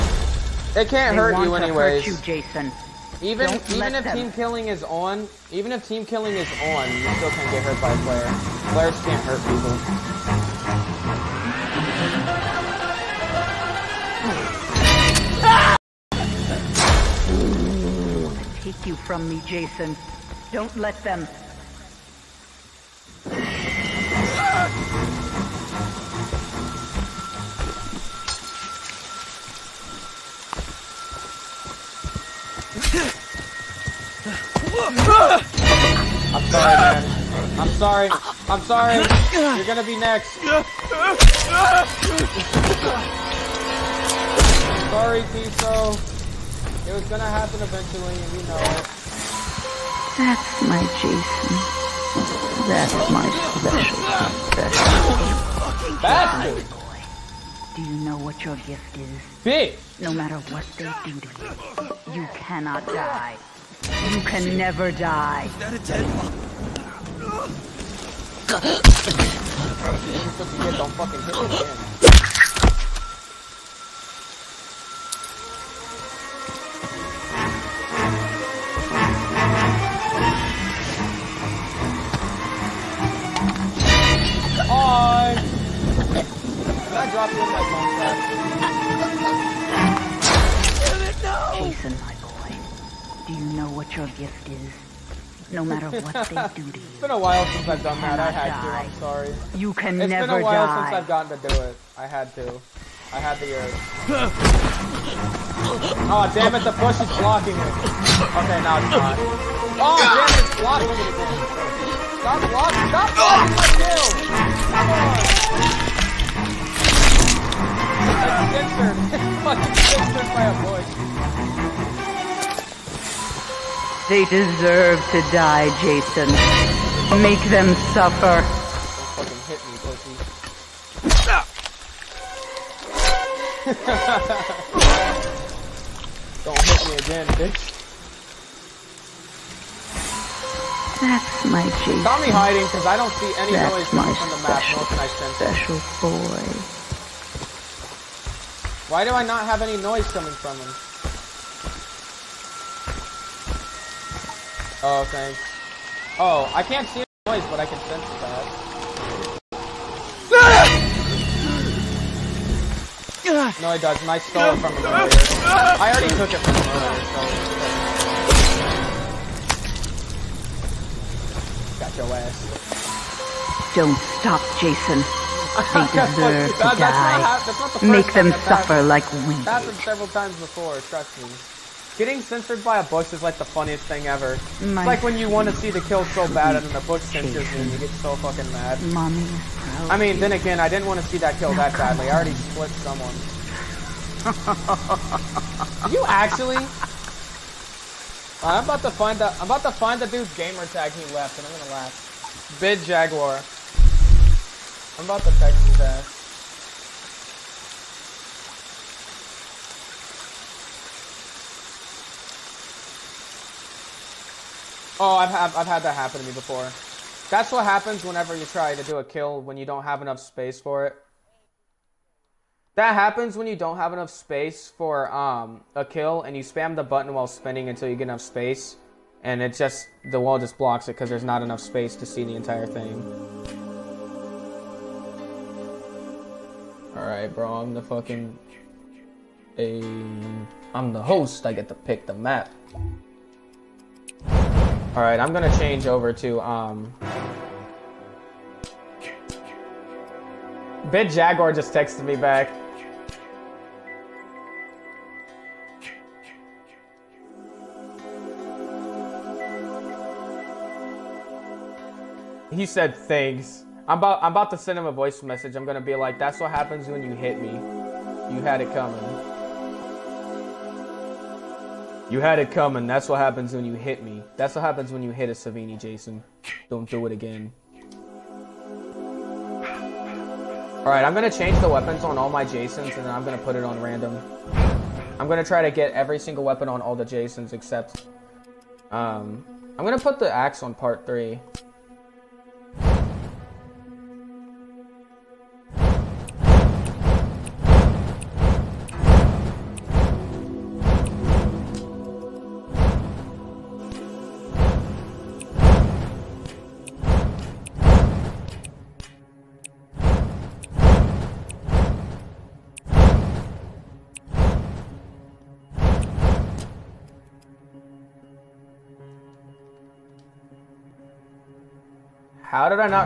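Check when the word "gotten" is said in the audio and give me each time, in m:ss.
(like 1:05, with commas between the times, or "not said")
1:41.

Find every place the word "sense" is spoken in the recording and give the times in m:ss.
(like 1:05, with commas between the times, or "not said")
2:25, 2:37.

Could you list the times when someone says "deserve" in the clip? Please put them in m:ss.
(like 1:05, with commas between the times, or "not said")
2:04, 2:56.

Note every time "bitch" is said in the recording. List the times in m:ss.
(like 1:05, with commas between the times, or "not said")
0:59, 2:17.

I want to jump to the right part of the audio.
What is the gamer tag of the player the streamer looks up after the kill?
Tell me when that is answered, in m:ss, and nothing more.
3:22.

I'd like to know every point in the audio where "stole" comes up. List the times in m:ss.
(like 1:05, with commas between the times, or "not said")
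2:44.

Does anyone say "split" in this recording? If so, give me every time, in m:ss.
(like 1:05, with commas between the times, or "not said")
3:12.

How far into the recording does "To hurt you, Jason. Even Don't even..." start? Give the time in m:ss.
0:02.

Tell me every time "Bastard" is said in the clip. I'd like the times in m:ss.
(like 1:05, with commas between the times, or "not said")
0:56.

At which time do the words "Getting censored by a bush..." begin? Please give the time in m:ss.
3:01.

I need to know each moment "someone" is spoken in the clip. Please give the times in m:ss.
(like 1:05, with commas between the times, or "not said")
3:12.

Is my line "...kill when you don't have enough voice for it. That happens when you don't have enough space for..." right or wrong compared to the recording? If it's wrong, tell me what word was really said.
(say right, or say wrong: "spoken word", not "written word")
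wrong: "space", not "voice".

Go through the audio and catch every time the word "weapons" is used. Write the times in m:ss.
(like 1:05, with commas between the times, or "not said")
4:41, 4:46.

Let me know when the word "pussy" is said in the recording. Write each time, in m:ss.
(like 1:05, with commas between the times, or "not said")
2:09.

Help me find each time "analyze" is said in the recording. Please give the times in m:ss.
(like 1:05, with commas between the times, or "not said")
not said.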